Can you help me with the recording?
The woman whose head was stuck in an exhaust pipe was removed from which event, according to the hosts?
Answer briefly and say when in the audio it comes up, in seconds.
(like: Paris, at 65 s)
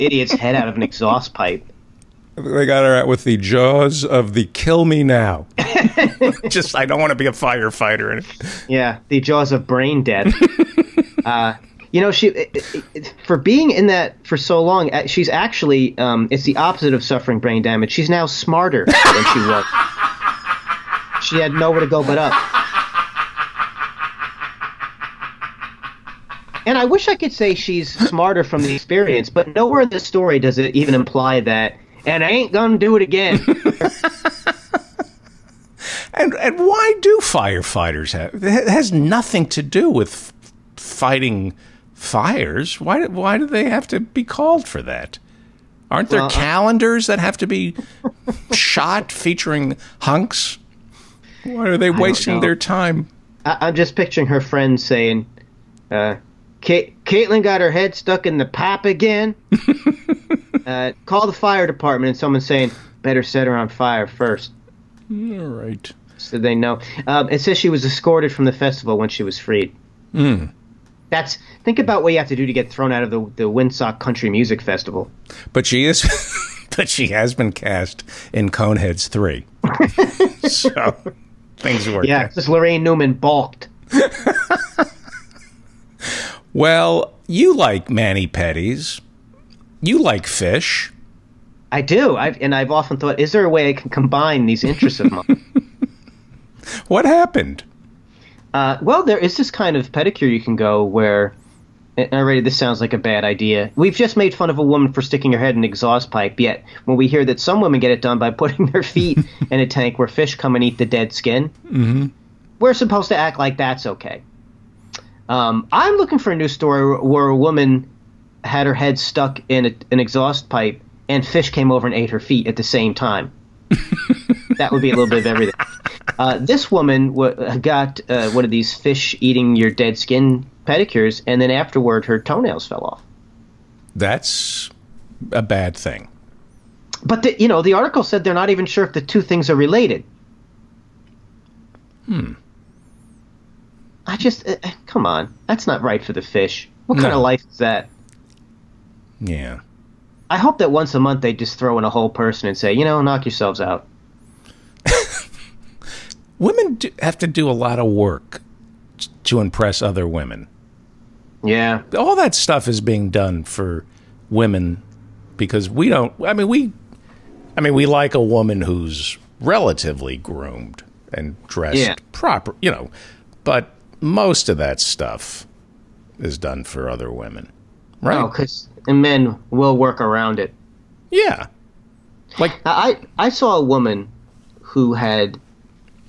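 Winstock Country Music Festival, at 73 s.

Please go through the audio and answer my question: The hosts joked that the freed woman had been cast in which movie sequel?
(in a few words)
Coneheads 3.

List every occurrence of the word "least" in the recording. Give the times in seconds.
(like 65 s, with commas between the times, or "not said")
not said.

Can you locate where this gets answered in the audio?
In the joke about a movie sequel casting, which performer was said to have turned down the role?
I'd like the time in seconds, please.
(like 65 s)
82 s.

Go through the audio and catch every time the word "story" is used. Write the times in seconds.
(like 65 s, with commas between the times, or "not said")
29 s, 116 s.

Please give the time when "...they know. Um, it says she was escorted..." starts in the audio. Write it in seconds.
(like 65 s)
66 s.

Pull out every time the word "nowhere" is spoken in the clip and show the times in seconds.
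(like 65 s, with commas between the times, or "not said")
21 s, 29 s.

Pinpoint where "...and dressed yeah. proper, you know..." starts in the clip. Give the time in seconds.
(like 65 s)
171 s.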